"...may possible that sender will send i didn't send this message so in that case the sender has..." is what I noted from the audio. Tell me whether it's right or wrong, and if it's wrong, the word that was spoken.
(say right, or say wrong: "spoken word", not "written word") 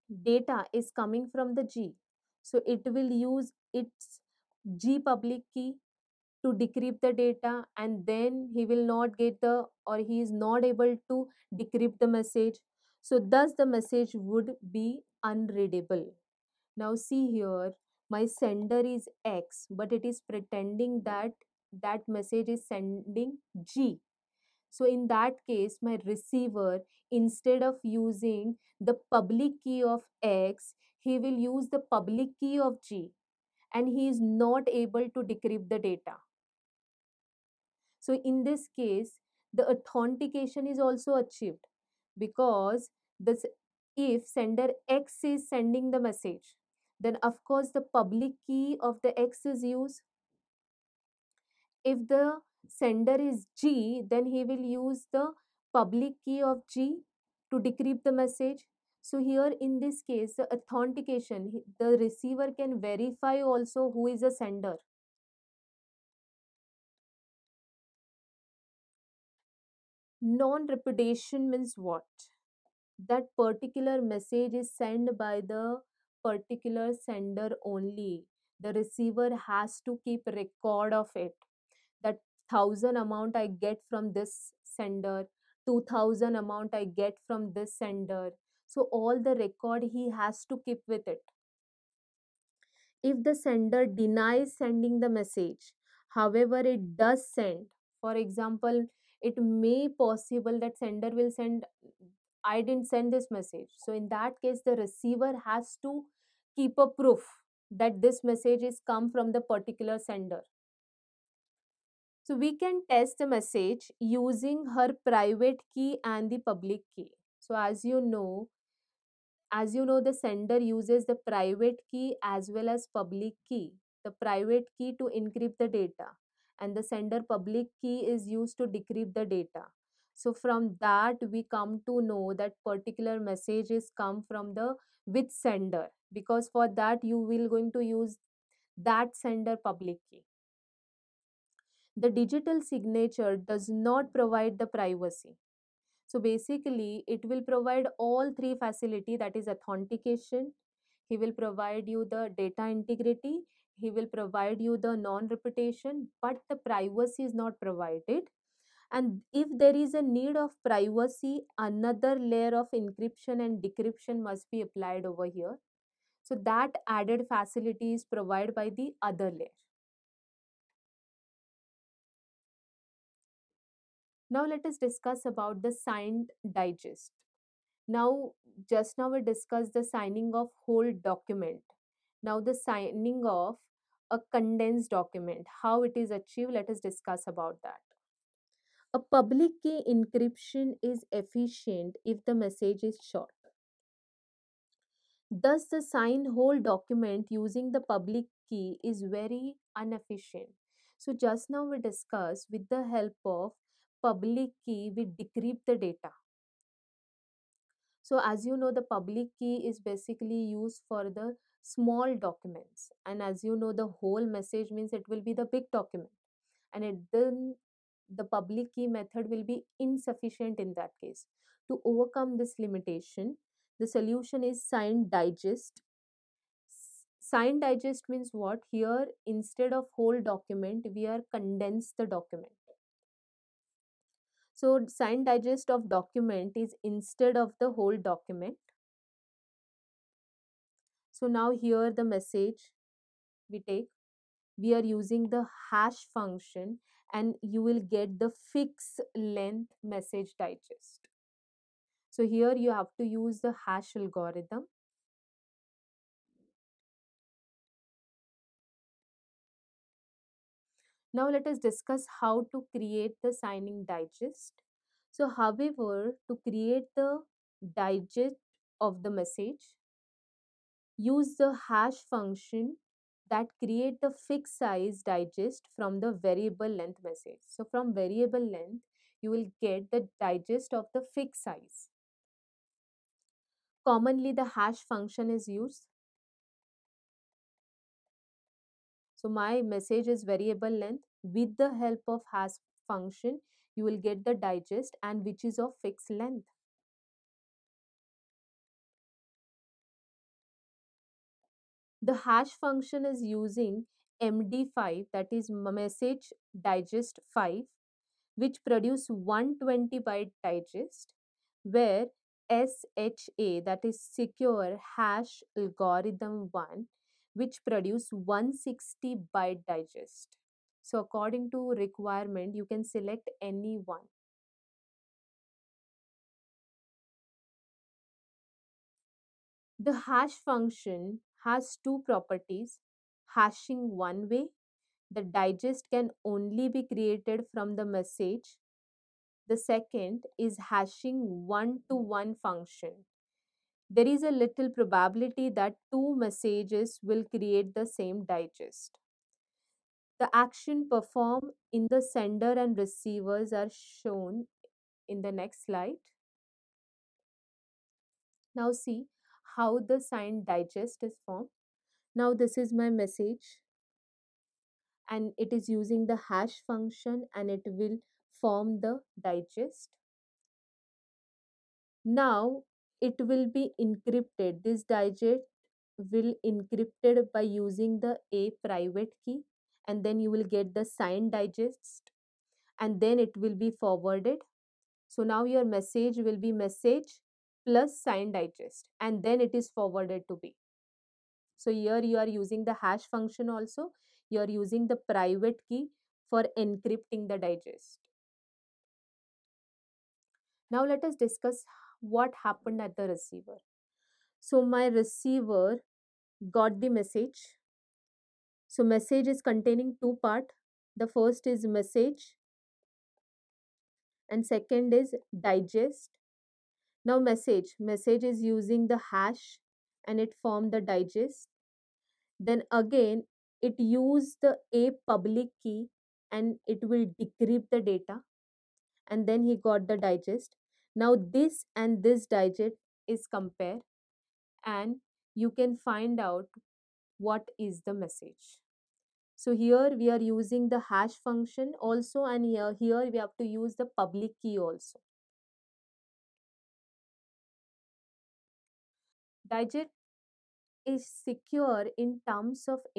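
wrong: "receiver", not "sender".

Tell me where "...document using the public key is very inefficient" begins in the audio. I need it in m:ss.
3:16.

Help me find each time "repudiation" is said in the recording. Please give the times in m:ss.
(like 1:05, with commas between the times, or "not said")
1:10, 2:35.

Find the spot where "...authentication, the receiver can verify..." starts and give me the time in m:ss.
1:00.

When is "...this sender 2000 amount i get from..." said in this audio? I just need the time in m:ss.
1:24.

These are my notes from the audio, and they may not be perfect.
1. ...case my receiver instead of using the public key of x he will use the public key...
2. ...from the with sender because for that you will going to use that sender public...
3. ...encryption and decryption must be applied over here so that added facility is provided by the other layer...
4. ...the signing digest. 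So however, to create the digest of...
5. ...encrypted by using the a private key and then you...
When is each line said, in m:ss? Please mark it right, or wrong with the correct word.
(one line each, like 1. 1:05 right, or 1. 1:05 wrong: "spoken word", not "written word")
1. 0:25 right
2. 2:14 right
3. 2:42 right
4. 4:23 right
5. 6:16 right.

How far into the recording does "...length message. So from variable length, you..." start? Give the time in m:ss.
4:36.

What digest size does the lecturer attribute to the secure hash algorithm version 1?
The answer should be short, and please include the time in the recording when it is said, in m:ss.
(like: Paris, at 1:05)
160 byte, at 5:18.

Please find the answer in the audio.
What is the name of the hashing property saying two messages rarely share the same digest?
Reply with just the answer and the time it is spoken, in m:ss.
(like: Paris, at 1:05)
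one to one function, at 5:40.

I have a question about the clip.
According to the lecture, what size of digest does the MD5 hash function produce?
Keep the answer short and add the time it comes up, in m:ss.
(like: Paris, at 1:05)
120 byte, at 5:09.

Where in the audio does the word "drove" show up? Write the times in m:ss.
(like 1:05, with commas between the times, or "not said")
not said.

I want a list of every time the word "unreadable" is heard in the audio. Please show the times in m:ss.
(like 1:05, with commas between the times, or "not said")
0:15.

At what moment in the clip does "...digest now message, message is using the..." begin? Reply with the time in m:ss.
6:55.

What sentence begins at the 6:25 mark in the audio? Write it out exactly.
So now your message will be message plus sign digest and then it is forwarded to B.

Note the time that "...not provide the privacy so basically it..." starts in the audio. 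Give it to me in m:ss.
2:23.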